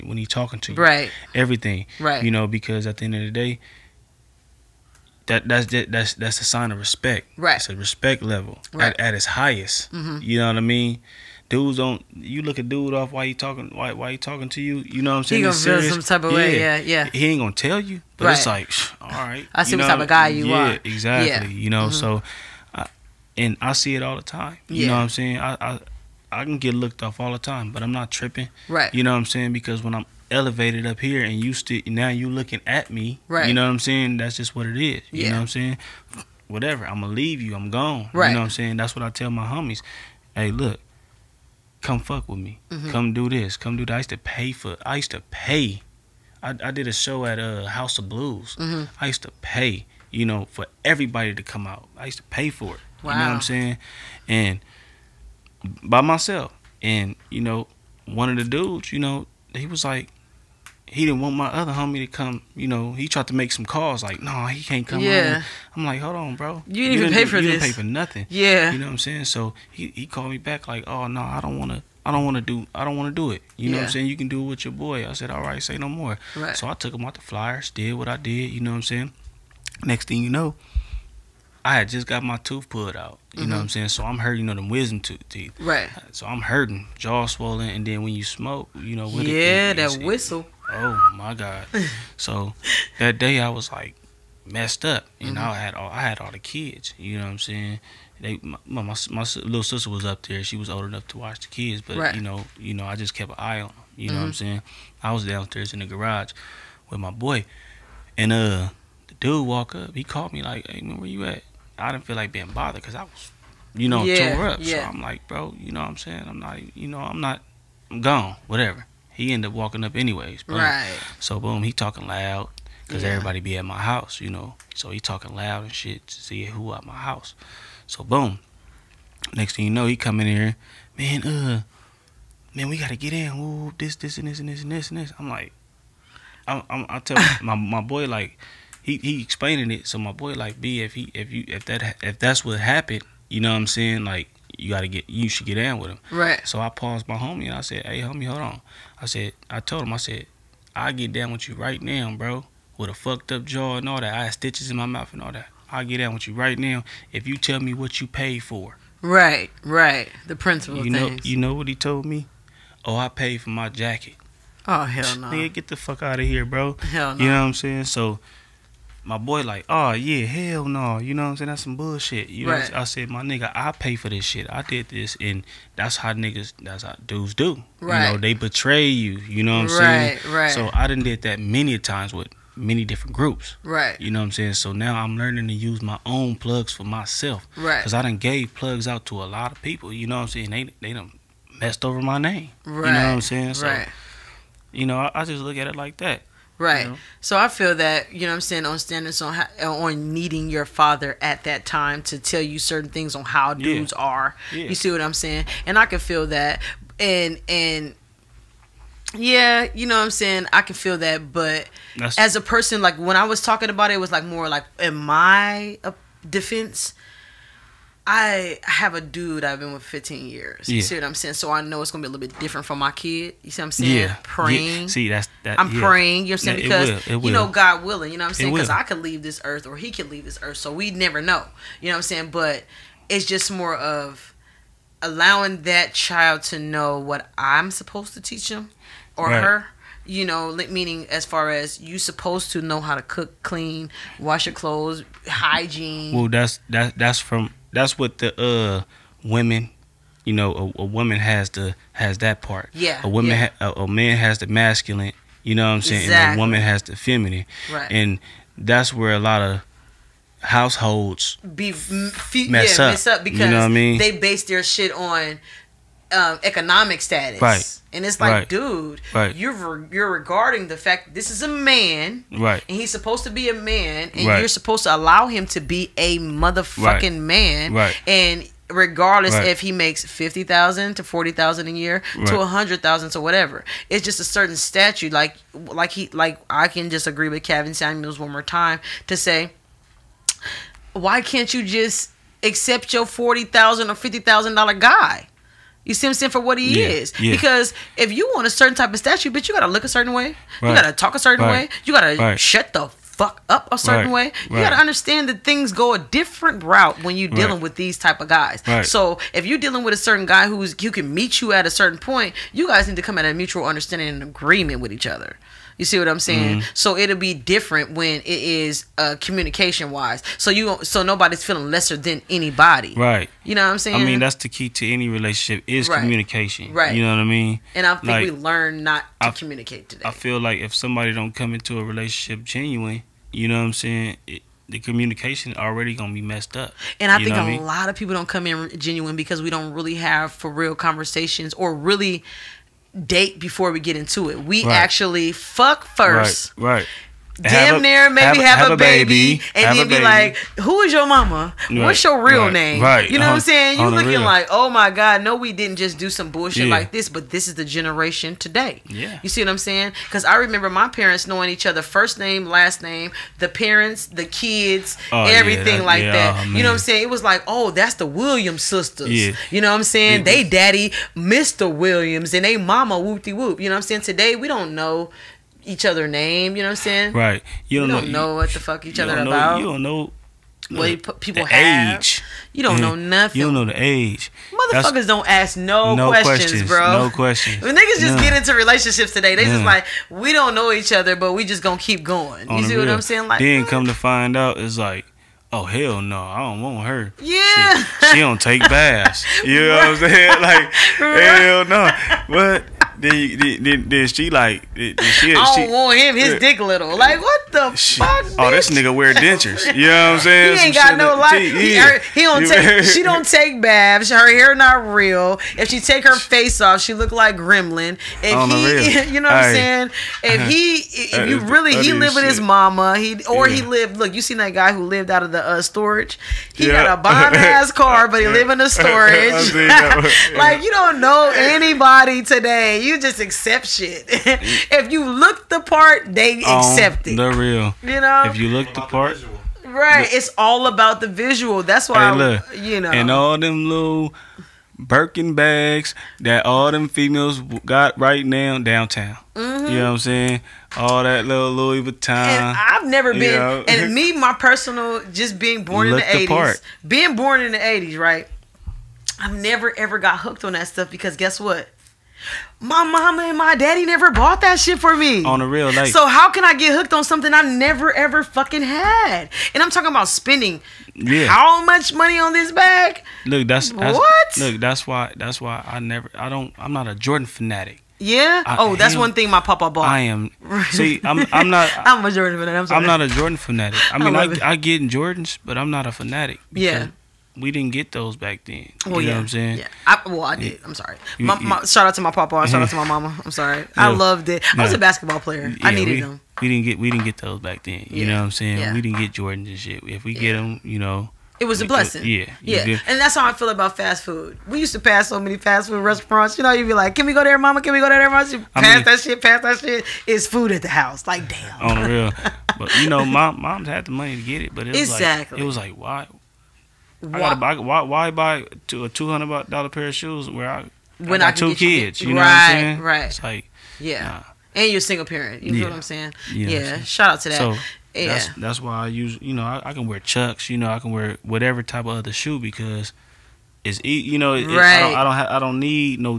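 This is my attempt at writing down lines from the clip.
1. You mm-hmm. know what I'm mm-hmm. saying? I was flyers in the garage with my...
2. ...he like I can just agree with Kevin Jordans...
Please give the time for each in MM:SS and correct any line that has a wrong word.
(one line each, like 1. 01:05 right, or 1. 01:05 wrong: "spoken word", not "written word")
1. 01:43 wrong: "downstairs", not "flyers"
2. 04:45 wrong: "Samuels", not "Jordans".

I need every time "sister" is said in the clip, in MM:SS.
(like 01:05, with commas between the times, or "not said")
01:39, 06:08.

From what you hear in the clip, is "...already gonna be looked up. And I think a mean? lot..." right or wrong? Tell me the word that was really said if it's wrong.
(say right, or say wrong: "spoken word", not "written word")
wrong: "messed", not "looked".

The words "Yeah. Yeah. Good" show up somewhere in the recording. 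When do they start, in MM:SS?
08:22.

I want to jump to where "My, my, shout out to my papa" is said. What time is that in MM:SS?
08:11.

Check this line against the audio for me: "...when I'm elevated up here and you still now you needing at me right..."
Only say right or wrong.
wrong.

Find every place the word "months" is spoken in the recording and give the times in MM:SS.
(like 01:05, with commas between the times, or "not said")
not said.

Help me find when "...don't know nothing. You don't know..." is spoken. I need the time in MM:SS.
06:22.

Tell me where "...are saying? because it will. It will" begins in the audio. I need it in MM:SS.
03:46.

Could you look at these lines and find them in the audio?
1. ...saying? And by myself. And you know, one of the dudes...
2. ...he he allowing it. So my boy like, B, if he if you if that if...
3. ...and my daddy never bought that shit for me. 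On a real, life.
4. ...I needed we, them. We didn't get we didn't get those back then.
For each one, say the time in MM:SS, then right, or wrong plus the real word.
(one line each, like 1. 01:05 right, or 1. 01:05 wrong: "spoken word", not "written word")
1. 00:53 right
2. 02:18 wrong: "explaining", not "allowing"
3. 07:43 right
4. 08:15 right.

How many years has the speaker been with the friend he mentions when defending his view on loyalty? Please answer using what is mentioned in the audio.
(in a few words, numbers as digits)
15.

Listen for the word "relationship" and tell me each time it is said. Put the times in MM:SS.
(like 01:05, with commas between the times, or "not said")
05:25, 05:31, 06:28.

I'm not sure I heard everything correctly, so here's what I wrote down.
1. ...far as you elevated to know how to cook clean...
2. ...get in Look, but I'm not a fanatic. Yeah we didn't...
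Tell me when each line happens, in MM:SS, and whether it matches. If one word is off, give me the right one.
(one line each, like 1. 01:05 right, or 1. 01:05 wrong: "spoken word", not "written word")
1. 04:01 wrong: "supposed", not "elevated"
2. 08:04 wrong: "Jordans", not "Look".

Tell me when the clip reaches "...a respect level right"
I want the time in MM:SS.
00:07.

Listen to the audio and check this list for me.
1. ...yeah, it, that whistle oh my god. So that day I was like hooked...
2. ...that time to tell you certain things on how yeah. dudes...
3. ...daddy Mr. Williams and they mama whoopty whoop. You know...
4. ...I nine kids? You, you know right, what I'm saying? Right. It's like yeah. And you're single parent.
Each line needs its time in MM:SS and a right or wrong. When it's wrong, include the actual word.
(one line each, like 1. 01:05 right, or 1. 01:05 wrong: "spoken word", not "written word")
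1. 01:29 wrong: "messed", not "hooked"
2. 03:21 right
3. 06:10 right
4. 08:41 wrong: "two", not "nine".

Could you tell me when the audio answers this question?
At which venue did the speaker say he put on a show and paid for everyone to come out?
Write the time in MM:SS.
00:47.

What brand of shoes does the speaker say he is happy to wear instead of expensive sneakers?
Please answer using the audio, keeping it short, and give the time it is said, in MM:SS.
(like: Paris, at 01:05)
Chucks, at 08:50.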